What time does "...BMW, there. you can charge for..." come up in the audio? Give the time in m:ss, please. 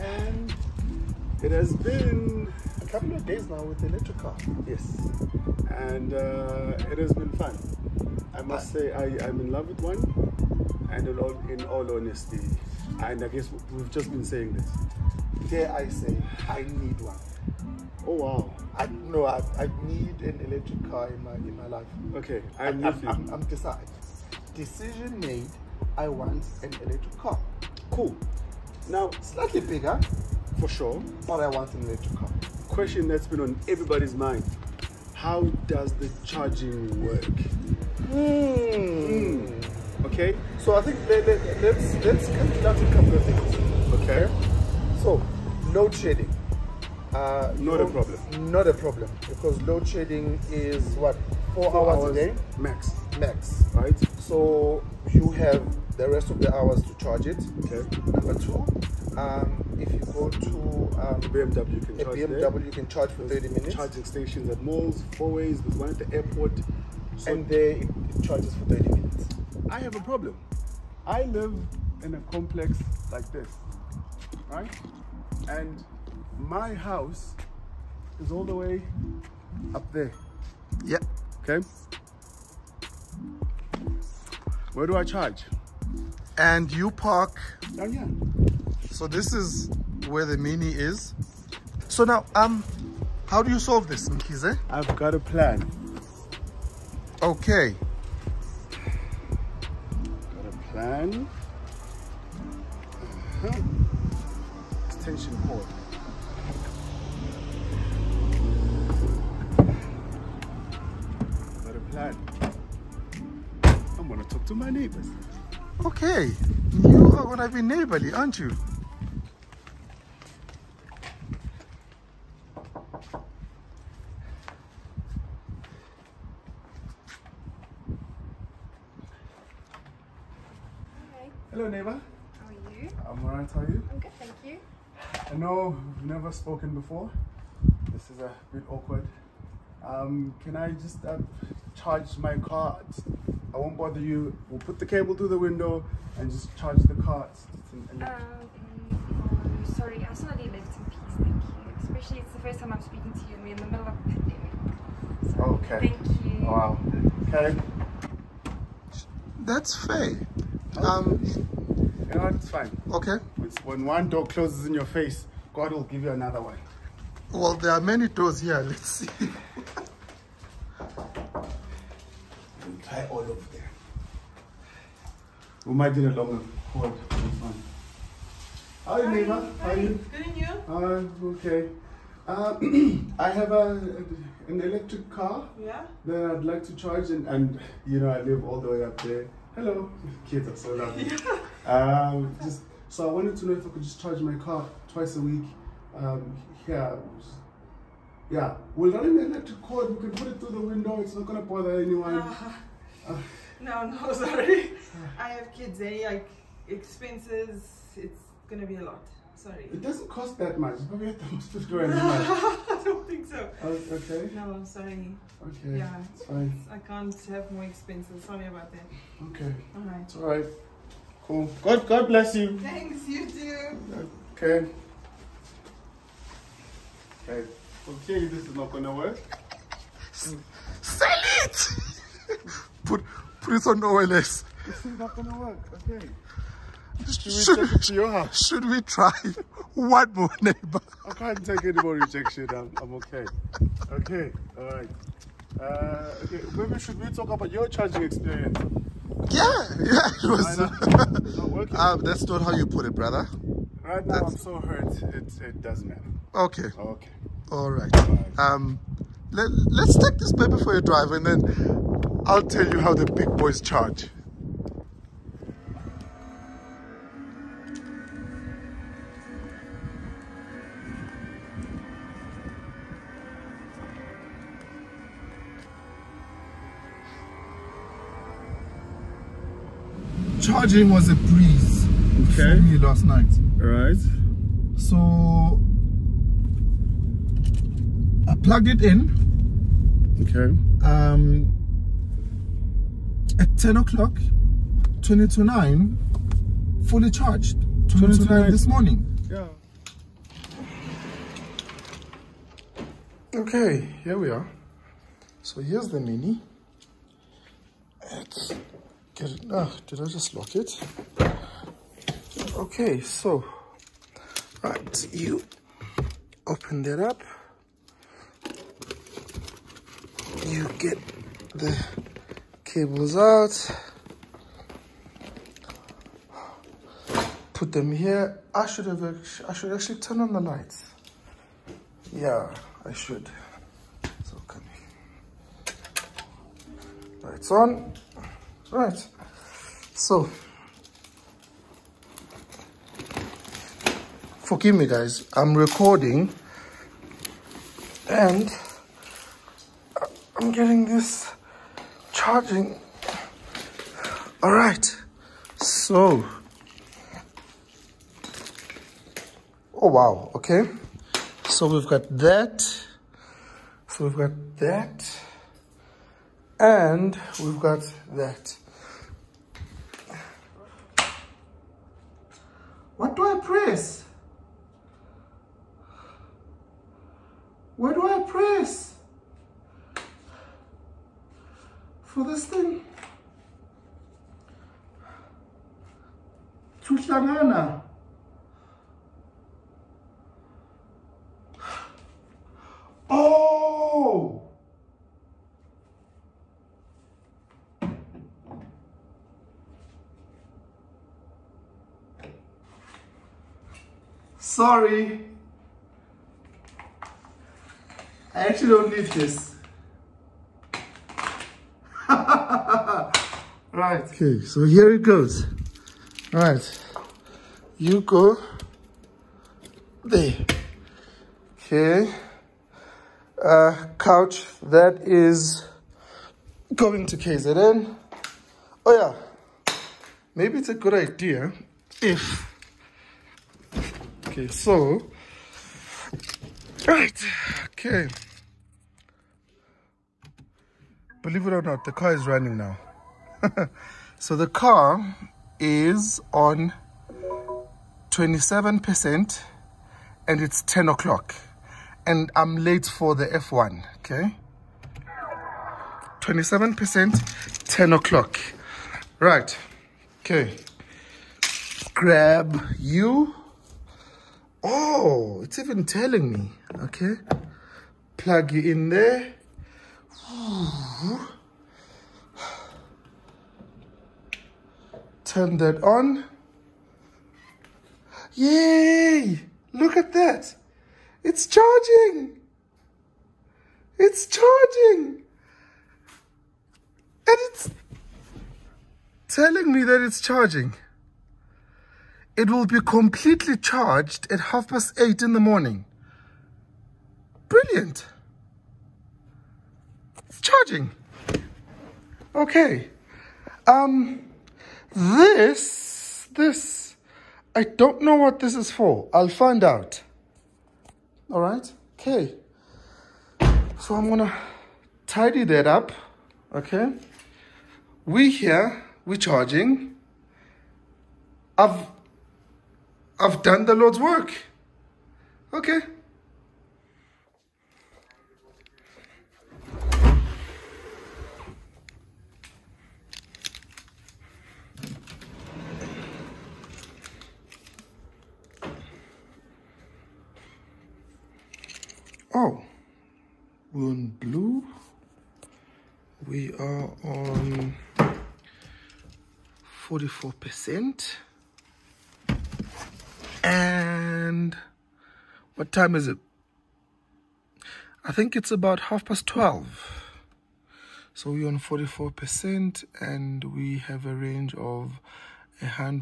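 1:02.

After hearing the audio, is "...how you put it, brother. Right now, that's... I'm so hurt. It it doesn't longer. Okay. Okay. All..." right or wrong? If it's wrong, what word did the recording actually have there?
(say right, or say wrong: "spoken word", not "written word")
wrong: "matter", not "longer".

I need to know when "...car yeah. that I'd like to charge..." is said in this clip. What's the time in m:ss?
3:05.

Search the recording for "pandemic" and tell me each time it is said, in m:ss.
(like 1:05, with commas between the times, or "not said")
2:34.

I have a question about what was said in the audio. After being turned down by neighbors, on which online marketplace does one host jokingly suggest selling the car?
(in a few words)
OLX.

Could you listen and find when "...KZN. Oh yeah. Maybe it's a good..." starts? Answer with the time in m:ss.
7:07.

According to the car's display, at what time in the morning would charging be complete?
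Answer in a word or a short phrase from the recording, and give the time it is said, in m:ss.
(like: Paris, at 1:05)
Half past eight, at 8:14.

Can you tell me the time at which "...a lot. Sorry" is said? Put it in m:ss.
3:28.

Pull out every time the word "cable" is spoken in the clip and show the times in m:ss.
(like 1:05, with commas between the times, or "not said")
2:24, 5:22.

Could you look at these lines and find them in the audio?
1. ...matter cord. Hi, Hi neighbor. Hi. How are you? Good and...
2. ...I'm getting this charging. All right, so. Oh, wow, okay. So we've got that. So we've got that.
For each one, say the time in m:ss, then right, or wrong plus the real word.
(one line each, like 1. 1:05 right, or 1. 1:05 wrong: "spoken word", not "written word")
1. 2:56 wrong: "longer", not "matter"
2. 5:50 right.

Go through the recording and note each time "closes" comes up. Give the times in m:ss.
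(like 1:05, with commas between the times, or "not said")
2:44.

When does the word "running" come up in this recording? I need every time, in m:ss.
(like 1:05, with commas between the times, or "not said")
7:22.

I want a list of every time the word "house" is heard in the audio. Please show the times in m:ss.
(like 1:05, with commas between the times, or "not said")
1:16, 3:58.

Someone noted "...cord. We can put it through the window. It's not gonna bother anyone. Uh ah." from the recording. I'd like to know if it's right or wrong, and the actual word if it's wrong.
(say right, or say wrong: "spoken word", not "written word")
right.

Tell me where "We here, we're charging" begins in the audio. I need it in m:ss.
8:38.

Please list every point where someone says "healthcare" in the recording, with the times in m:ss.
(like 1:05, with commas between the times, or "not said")
not said.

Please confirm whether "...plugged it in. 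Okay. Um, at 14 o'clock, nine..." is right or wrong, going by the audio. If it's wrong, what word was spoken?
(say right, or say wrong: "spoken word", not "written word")
wrong: "10", not "14".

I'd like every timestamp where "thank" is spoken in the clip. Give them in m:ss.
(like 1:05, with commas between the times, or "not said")
2:14, 2:31, 2:35, 3:42.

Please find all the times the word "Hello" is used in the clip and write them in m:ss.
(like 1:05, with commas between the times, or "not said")
2:11, 3:09.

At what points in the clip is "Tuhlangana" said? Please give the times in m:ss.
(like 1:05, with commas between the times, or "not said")
6:26.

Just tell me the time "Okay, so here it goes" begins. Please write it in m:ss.
6:54.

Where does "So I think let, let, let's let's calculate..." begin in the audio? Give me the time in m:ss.
0:40.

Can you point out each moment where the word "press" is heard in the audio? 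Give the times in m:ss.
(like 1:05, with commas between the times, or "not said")
6:13, 6:18.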